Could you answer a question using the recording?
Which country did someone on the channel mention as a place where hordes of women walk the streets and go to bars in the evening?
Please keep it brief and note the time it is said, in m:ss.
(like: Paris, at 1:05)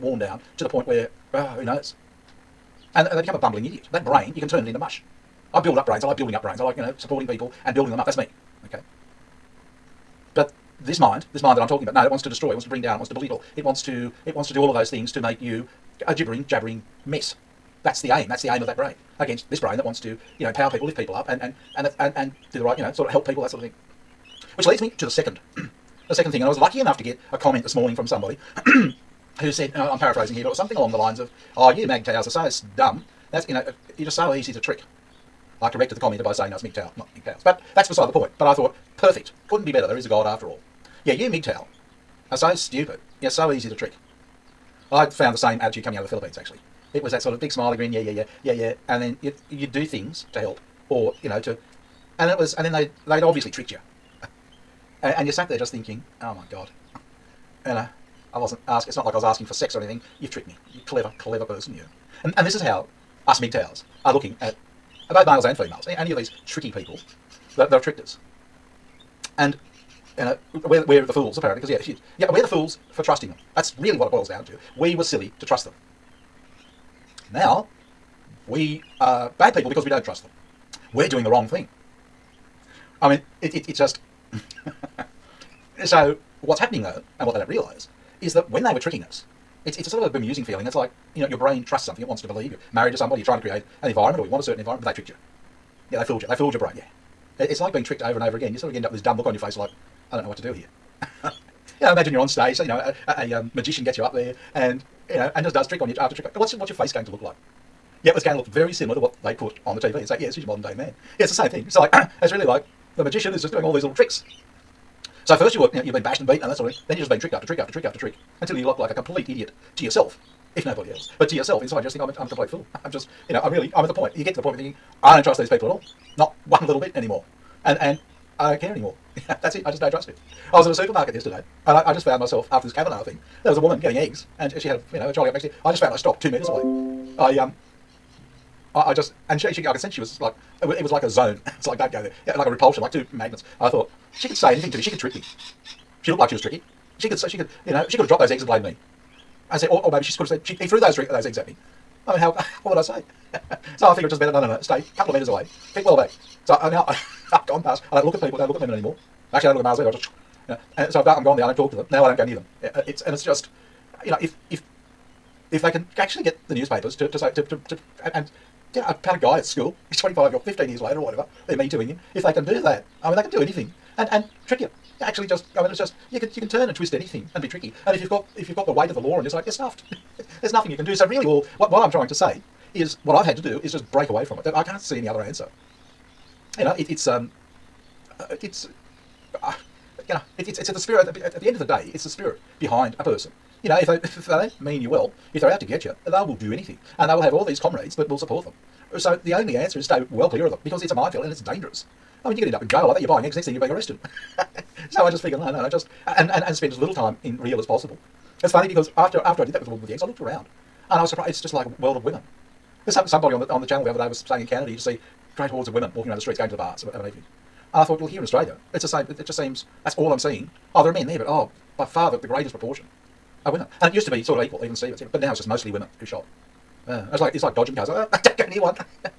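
Canada, at 3:34.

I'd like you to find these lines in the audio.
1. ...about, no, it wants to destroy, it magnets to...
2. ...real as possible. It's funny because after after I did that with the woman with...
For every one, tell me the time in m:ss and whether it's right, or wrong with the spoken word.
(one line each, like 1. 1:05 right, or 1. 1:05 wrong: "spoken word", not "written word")
1. 0:11 wrong: "wants", not "magnets"
2. 3:27 right.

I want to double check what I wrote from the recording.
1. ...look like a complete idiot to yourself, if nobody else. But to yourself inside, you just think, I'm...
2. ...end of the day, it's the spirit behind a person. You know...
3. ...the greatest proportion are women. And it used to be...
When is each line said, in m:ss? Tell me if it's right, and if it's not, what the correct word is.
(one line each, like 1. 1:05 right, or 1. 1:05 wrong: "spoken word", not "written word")
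1. 1:58 right
2. 3:11 right
3. 3:42 right.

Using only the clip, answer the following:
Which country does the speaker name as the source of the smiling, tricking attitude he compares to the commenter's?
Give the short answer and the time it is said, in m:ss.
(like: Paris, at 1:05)
Philippines, at 0:46.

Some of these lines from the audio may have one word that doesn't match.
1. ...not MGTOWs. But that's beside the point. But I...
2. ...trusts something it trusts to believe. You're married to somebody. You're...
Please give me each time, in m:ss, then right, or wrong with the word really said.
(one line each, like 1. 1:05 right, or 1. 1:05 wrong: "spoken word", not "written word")
1. 0:36 right
2. 1:31 wrong: "wants", not "trusts".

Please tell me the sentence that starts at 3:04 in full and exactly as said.
I can't see any other answer.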